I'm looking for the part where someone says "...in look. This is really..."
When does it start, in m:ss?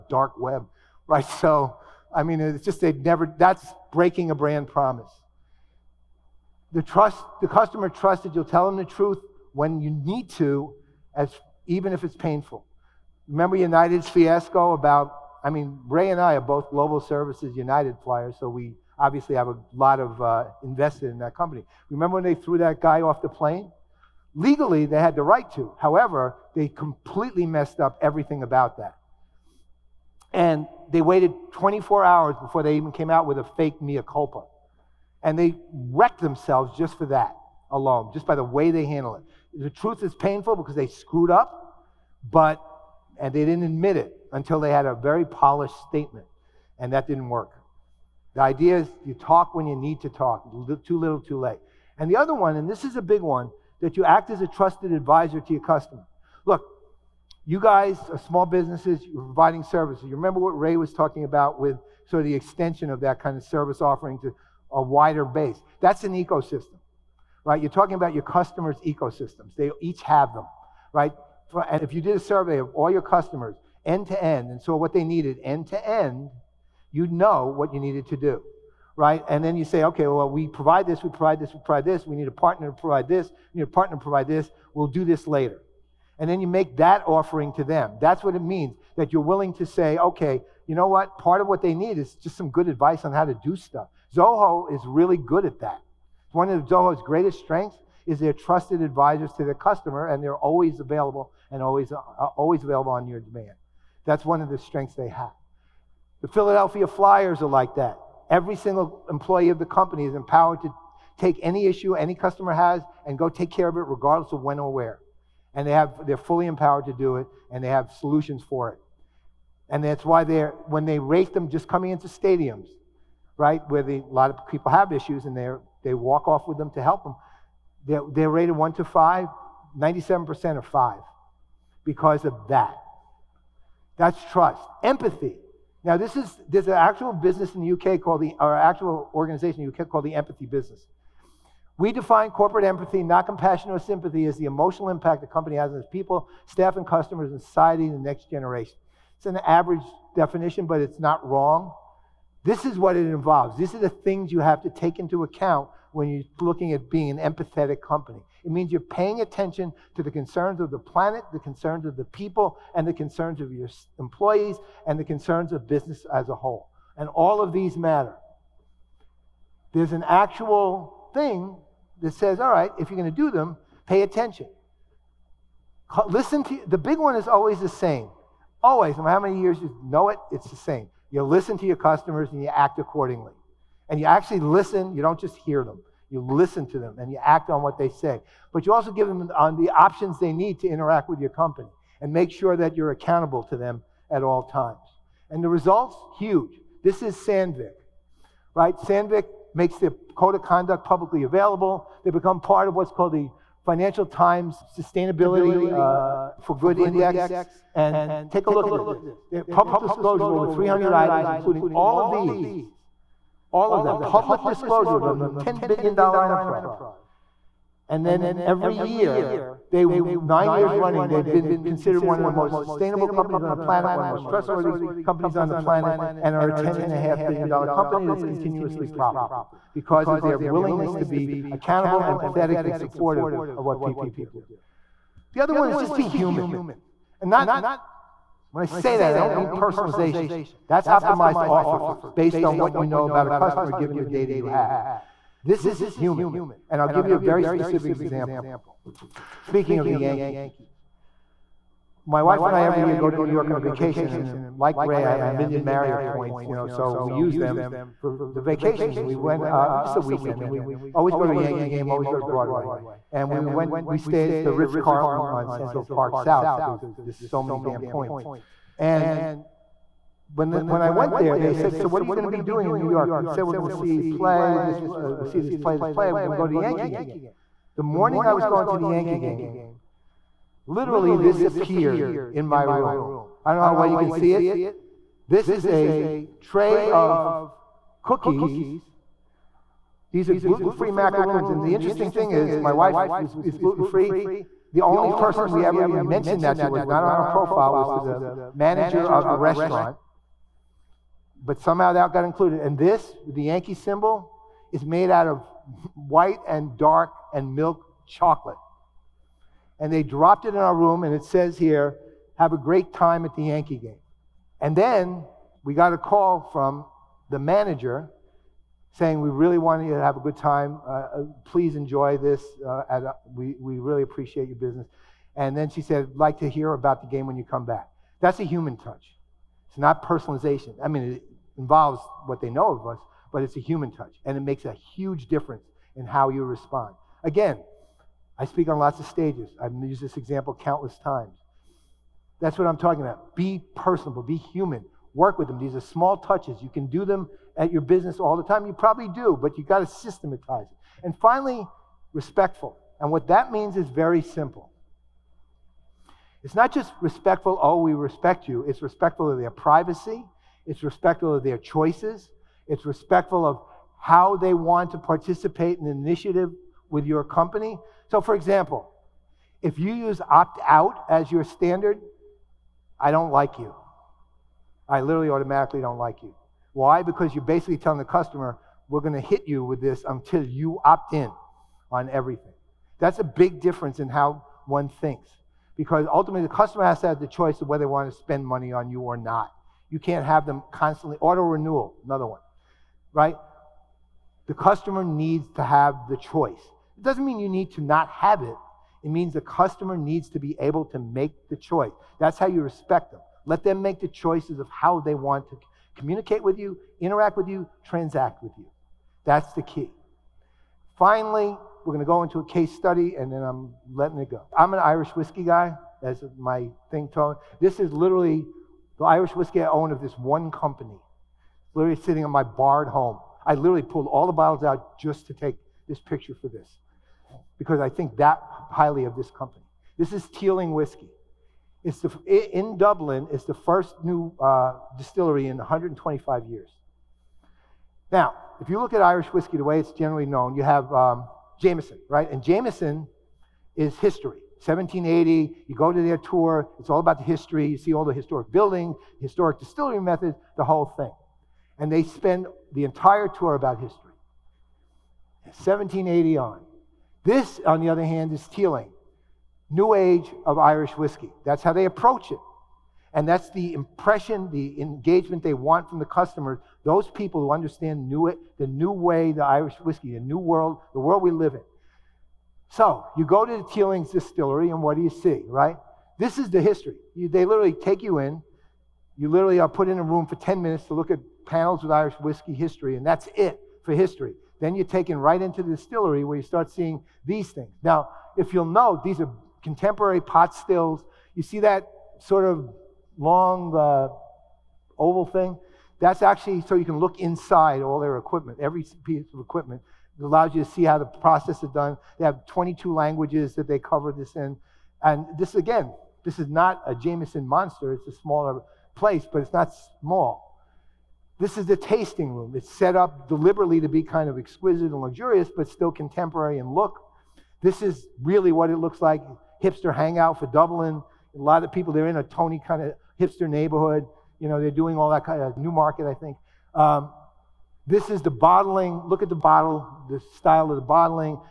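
8:36.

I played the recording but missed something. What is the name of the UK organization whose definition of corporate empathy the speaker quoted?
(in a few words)
The Empathy Business.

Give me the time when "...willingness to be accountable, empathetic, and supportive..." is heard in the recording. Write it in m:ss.
3:50.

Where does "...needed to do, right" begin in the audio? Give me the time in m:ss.
1:17.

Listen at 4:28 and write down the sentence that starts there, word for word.
And when, the, when I went there, they said, So what are you going to be doing in New York?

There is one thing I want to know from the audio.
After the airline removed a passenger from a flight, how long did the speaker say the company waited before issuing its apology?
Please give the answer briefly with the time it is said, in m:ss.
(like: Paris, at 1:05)
24 hours, at 0:31.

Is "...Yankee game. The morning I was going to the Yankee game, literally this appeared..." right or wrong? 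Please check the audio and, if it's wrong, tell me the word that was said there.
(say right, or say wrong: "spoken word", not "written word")
right.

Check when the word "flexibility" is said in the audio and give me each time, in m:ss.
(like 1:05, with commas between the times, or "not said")
not said.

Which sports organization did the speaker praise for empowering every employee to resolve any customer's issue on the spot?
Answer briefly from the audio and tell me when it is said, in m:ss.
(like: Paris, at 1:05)
Philadelphia Flyers, at 1:46.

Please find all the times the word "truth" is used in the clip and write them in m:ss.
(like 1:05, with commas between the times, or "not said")
0:08, 0:39.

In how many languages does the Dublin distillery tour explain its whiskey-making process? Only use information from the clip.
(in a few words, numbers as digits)
22.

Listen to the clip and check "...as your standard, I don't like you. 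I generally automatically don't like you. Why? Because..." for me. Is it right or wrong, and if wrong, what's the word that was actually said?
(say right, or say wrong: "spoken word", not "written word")
wrong: "literally", not "generally".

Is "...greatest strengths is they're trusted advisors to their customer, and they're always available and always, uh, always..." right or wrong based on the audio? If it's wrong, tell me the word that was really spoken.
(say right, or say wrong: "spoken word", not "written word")
right.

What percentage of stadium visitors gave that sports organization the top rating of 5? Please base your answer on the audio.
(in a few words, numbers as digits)
97%.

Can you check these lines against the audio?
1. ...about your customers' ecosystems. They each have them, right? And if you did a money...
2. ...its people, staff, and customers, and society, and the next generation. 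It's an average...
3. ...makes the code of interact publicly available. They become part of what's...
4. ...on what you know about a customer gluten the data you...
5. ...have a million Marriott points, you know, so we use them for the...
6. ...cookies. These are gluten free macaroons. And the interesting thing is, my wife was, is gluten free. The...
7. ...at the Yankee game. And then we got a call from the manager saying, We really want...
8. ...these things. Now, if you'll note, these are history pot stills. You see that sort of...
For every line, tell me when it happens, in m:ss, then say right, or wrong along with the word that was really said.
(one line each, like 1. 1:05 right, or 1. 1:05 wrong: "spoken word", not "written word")
1. 1:07 wrong: "survey", not "money"
2. 2:25 right
3. 3:19 wrong: "conduct", not "interact"
4. 4:02 wrong: "given", not "gluten"
5. 4:15 right
6. 4:48 right
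7. 5:13 right
8. 8:07 wrong: "contemporary", not "history".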